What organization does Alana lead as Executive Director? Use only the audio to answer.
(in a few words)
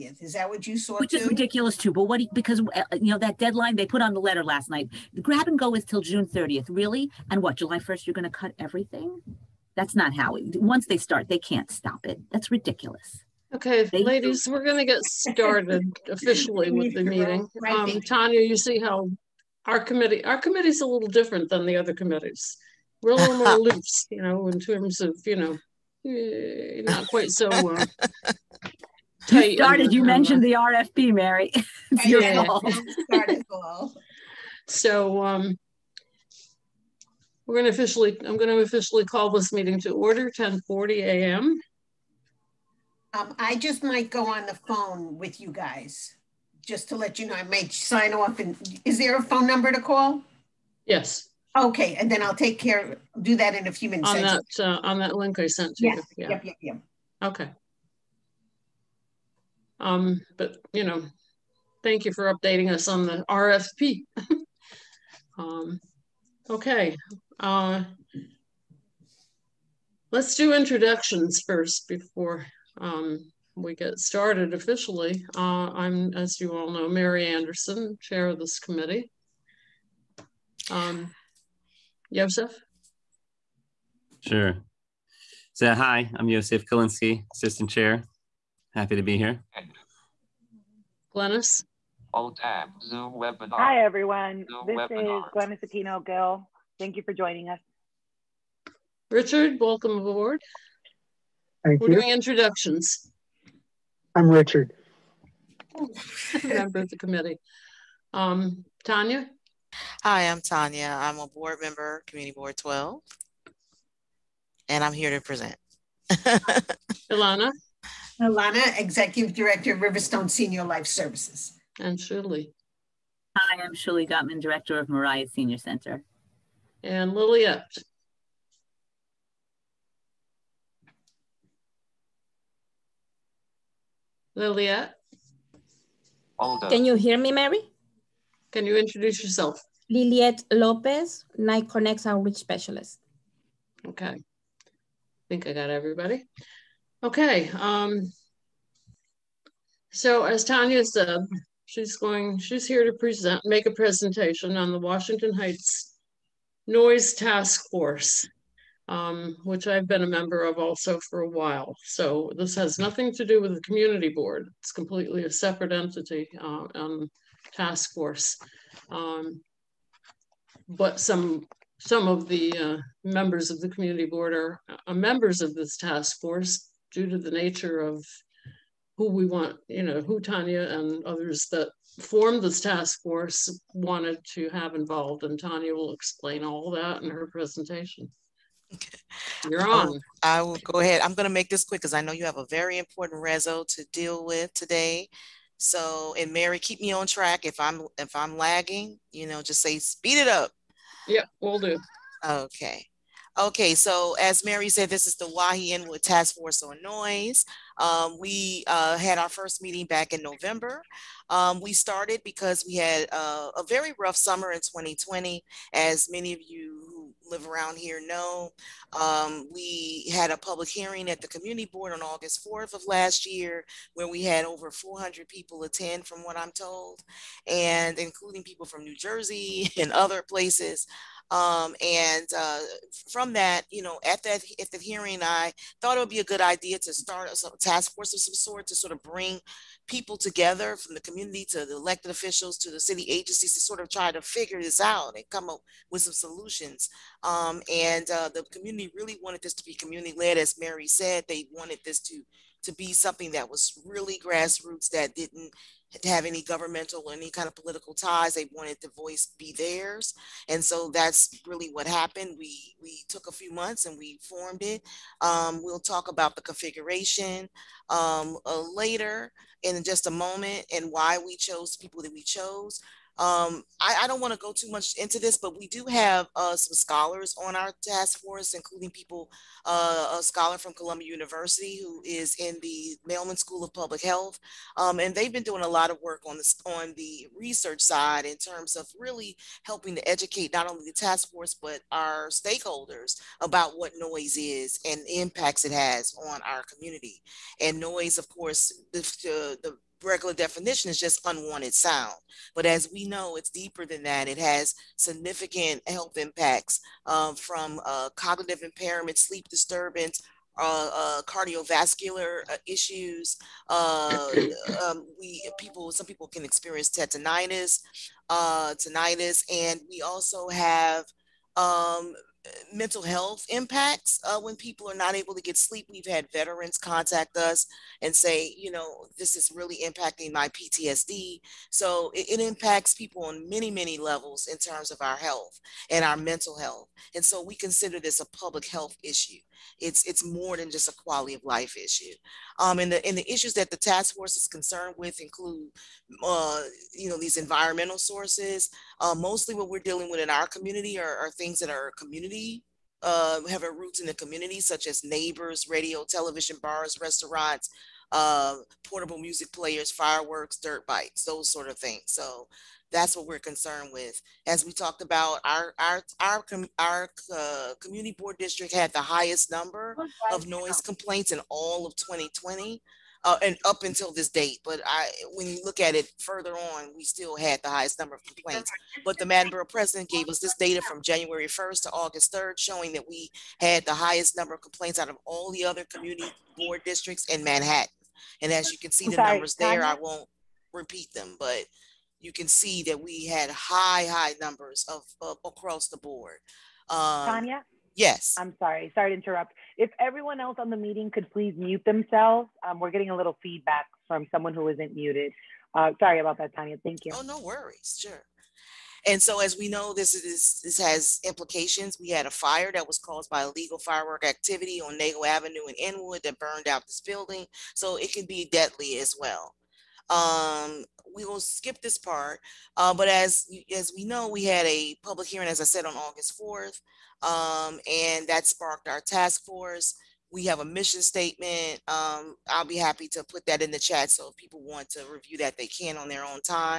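Riverstone Senior Life Services.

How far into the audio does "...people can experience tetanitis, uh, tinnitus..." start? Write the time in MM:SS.
05:16.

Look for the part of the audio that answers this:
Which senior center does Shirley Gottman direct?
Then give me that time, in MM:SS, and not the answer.
02:04.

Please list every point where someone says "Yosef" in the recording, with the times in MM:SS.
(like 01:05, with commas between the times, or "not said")
01:22, 01:26.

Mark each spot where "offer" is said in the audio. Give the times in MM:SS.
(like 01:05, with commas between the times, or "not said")
not said.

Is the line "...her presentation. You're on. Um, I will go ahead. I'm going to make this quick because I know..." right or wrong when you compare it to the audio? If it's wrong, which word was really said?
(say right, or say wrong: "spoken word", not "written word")
right.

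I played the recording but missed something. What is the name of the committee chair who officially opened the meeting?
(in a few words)
Mary Anderson.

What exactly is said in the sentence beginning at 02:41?
So this has nothing to do with the community board.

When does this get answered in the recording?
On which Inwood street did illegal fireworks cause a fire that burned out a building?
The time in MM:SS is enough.
06:54.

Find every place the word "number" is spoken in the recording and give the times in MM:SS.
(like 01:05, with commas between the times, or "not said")
00:49, 06:09, 06:17, 06:24, 06:29, 06:34.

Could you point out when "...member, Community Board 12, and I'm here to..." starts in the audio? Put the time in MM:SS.
01:51.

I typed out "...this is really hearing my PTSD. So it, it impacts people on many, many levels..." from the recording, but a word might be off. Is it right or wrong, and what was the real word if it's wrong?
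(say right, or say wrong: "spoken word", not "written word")
wrong: "impacting", not "hearing".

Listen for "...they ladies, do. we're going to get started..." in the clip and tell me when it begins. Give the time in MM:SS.
00:13.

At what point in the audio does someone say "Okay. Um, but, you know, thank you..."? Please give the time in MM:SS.
00:57.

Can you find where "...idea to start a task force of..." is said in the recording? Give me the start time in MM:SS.
03:56.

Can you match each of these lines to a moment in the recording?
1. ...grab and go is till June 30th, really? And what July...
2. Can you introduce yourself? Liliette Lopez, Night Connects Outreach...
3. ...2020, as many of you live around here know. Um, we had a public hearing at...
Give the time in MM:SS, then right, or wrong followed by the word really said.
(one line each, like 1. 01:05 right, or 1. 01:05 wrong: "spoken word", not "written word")
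1. 00:05 right
2. 02:18 right
3. 03:34 right.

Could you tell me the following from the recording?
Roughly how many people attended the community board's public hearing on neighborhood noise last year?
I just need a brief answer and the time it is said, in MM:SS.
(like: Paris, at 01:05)
over 400, at 03:44.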